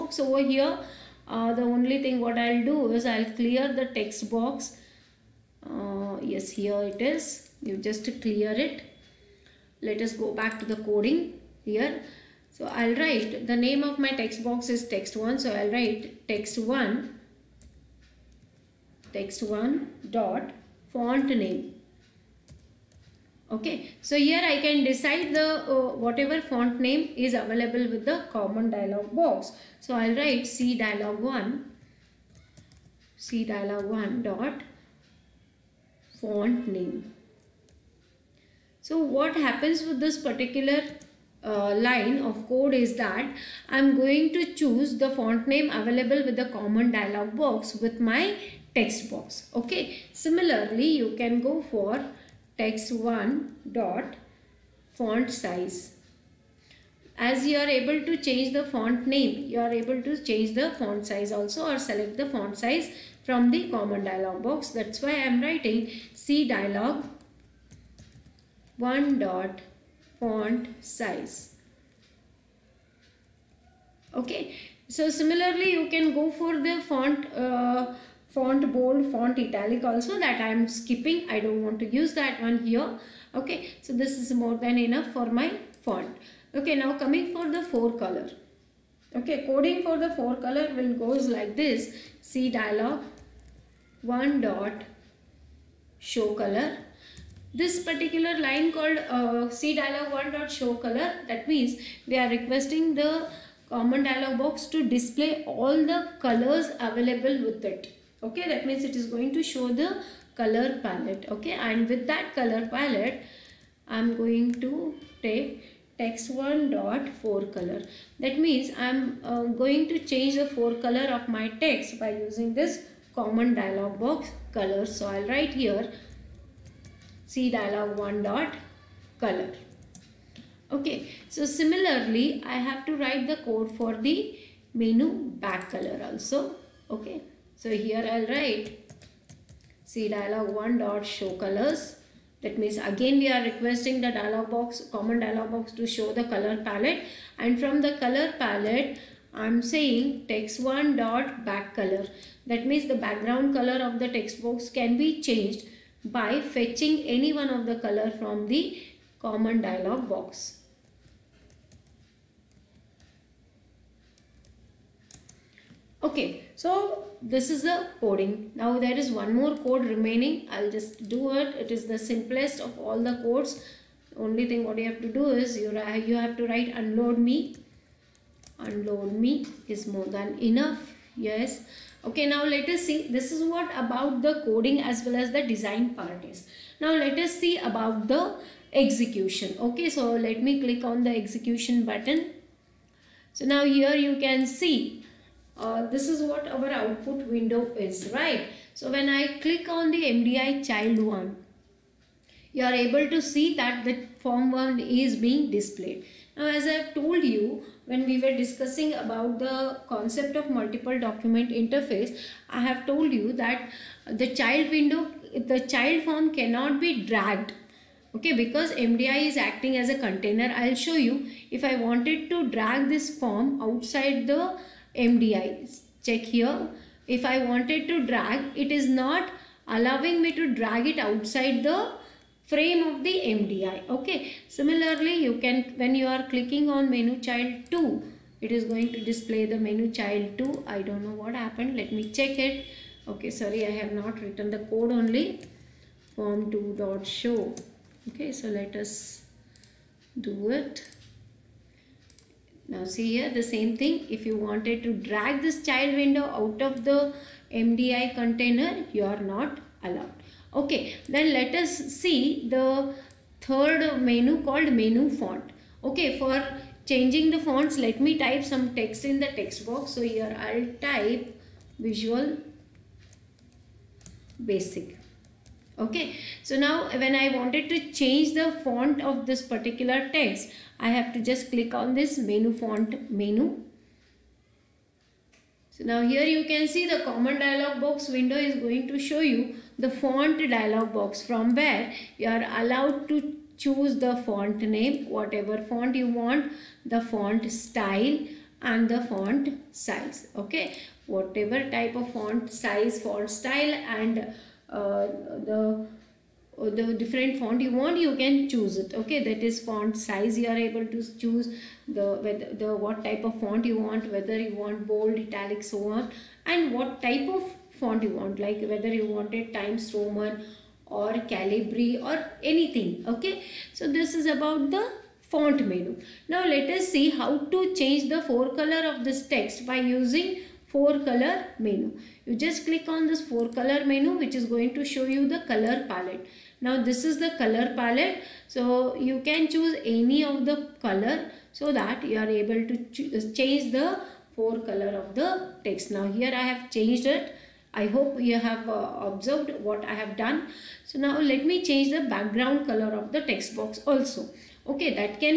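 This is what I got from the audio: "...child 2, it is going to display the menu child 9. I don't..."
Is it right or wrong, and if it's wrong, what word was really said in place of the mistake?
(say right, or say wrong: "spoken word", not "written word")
wrong: "2", not "9".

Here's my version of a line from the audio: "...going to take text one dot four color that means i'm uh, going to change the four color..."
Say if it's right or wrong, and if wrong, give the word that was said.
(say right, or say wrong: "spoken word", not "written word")
right.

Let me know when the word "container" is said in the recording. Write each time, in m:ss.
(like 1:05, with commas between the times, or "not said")
3:39, 4:18.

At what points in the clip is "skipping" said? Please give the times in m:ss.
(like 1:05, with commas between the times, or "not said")
1:20.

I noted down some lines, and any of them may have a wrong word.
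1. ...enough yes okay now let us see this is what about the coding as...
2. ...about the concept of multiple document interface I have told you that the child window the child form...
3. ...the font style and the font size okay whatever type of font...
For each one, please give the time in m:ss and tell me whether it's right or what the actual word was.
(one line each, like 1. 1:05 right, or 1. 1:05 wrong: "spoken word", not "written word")
1. 3:00 right
2. 3:28 right
3. 4:56 right.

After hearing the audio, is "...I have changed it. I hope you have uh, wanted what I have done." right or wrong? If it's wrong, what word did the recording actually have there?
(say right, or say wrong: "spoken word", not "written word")
wrong: "observed", not "wanted".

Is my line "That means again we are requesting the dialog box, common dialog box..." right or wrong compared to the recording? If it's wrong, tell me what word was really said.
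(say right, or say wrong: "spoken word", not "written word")
right.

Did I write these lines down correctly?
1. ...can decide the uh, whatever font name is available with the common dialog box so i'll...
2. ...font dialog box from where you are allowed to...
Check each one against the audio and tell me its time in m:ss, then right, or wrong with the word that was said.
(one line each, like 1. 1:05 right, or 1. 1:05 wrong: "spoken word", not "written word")
1. 0:24 right
2. 4:49 right.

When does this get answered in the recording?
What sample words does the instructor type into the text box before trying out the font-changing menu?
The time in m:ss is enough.
4:31.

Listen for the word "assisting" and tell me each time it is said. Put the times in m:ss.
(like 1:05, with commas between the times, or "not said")
not said.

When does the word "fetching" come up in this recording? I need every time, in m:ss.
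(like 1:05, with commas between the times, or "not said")
2:36.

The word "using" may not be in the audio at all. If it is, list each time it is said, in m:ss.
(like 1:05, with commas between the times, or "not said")
2:02, 5:29.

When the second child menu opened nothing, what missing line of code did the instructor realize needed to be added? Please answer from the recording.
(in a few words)
Form 2 dot show.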